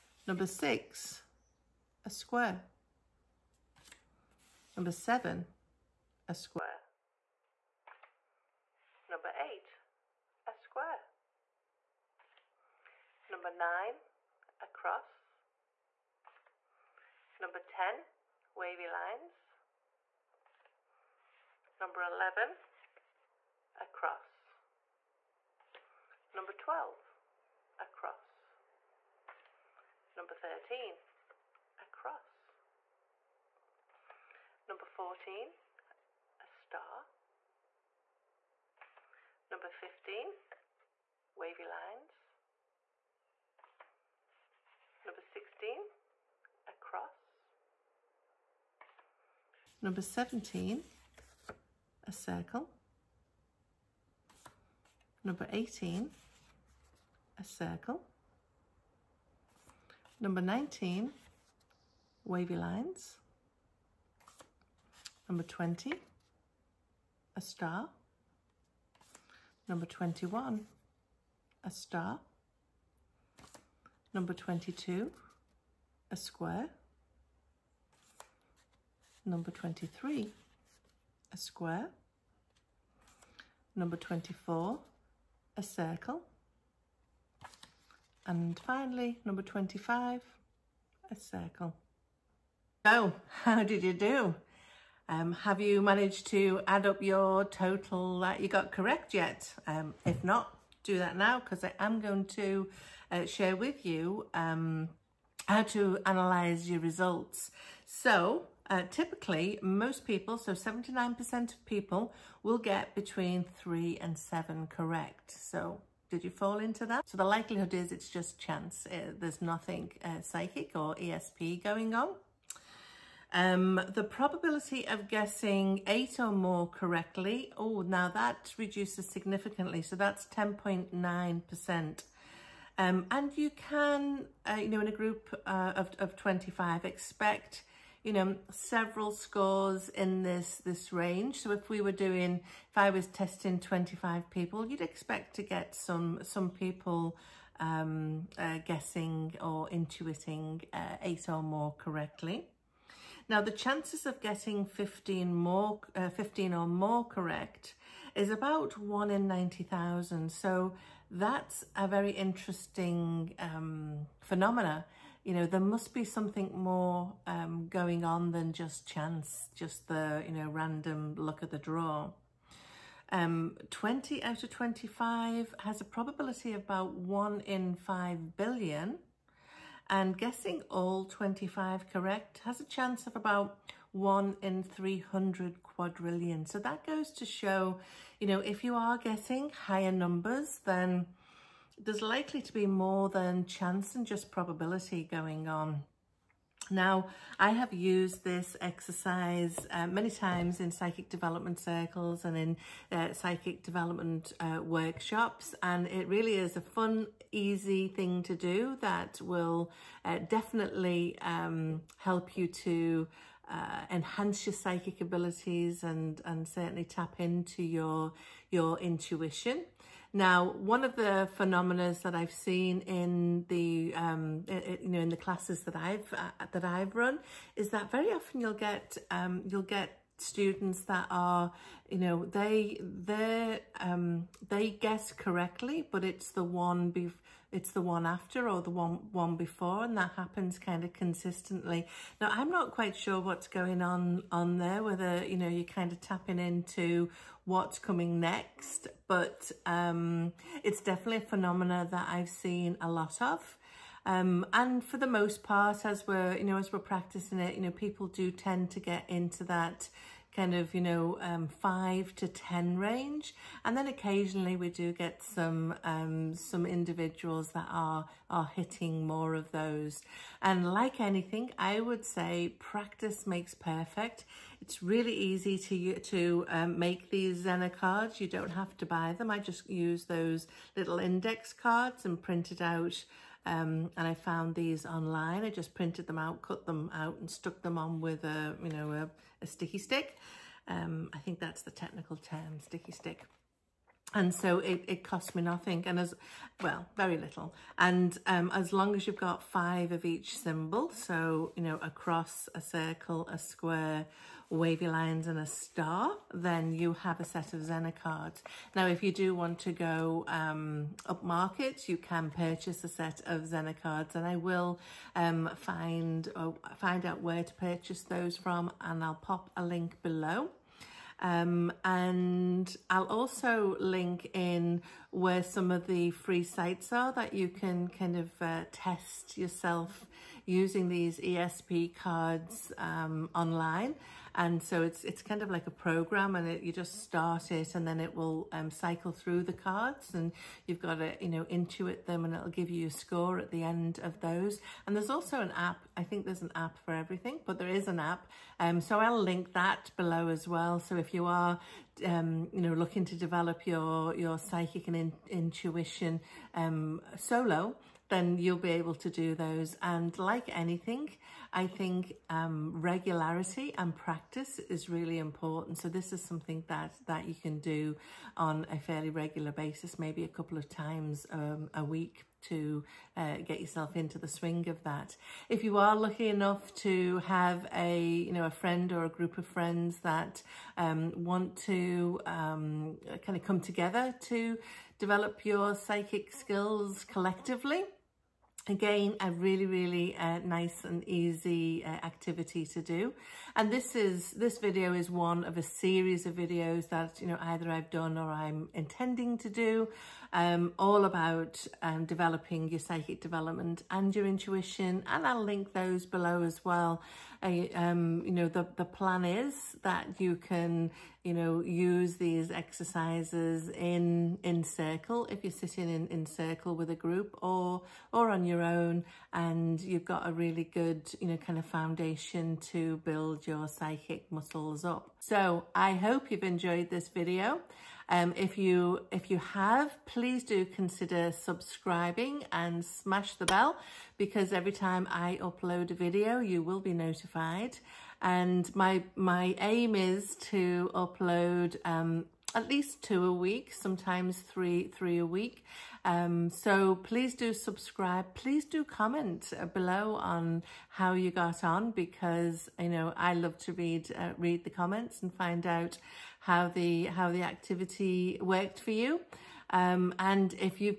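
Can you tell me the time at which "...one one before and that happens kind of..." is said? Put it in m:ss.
3:58.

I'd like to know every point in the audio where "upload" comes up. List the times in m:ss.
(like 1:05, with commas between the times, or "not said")
7:15, 7:20.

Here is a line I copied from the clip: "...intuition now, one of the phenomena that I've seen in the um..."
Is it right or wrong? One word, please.
right.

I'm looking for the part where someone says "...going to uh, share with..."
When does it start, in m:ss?
1:42.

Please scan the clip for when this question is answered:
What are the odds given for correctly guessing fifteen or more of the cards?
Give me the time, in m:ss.
2:38.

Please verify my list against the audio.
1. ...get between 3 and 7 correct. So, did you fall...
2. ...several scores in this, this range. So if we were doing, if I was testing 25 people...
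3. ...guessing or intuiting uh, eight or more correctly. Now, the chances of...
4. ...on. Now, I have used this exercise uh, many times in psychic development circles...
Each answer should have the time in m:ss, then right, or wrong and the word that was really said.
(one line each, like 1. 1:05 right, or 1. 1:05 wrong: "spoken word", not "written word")
1. 1:52 right
2. 2:18 right
3. 2:28 right
4. 3:15 right.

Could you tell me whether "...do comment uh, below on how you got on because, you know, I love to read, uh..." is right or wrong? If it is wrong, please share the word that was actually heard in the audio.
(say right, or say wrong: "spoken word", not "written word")
right.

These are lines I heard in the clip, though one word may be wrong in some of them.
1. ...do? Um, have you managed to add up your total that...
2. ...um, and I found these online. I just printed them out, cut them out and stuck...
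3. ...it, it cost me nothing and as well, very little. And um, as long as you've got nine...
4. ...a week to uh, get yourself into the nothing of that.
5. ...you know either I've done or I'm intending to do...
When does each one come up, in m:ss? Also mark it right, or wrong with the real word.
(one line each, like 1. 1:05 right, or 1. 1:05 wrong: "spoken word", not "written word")
1. 1:33 right
2. 4:43 right
3. 4:54 wrong: "five", not "nine"
4. 6:11 wrong: "swing", not "nothing"
5. 6:37 right.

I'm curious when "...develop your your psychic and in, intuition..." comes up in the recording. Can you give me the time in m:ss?
5:53.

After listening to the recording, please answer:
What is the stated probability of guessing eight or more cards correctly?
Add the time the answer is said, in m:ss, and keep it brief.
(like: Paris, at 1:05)
10.9%, at 2:10.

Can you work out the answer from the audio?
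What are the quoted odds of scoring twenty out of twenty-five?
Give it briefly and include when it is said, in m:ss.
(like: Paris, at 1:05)
1 in 5 billion, at 2:56.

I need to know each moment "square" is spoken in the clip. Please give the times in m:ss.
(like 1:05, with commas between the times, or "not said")
0:02, 0:06, 0:10, 1:16, 1:21, 5:03.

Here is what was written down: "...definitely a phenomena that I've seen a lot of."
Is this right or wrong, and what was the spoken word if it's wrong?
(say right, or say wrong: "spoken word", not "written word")
right.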